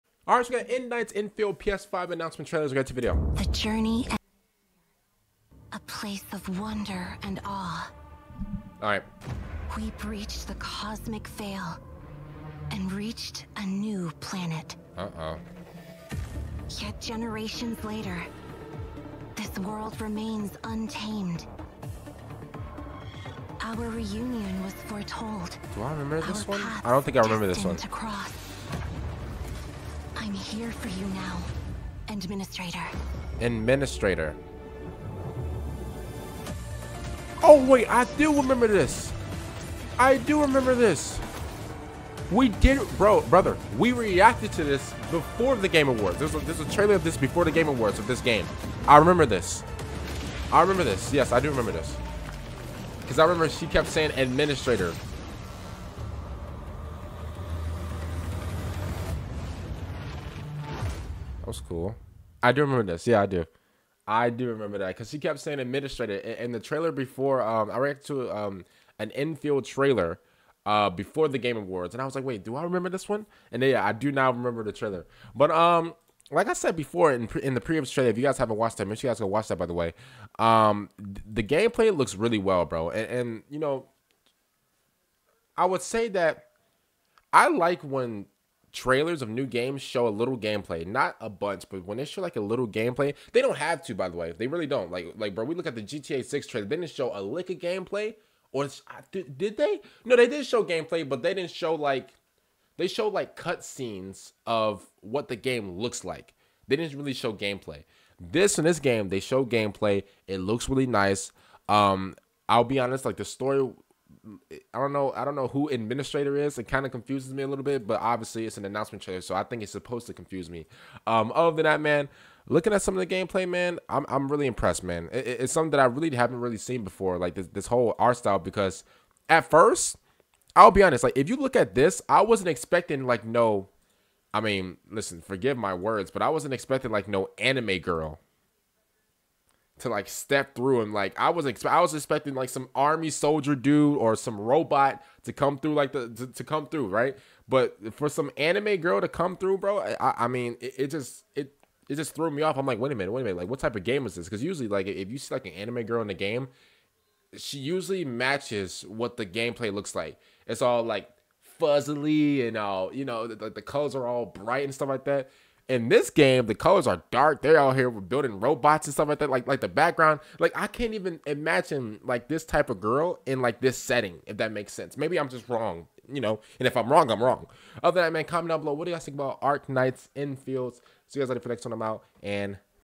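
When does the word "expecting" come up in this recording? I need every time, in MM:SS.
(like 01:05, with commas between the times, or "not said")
02:12, 02:16, 02:21.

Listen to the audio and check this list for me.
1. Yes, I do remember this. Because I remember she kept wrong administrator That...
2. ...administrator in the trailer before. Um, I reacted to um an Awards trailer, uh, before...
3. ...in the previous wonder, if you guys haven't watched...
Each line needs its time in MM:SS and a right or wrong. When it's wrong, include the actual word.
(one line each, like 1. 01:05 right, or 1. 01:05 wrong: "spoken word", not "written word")
1. 00:51 wrong: "saying", not "wrong"
2. 01:05 wrong: "Endfield", not "Awards"
3. 01:17 wrong: "trailer", not "wonder".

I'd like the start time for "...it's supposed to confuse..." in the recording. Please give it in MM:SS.
01:59.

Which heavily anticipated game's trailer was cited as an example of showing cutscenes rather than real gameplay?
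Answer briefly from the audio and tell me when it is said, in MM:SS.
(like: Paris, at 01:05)
GTA Six, at 01:35.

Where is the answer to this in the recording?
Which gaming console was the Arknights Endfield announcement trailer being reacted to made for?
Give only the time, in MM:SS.
00:01.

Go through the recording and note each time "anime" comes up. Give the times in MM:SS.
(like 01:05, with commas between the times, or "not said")
02:17, 02:28, 02:35.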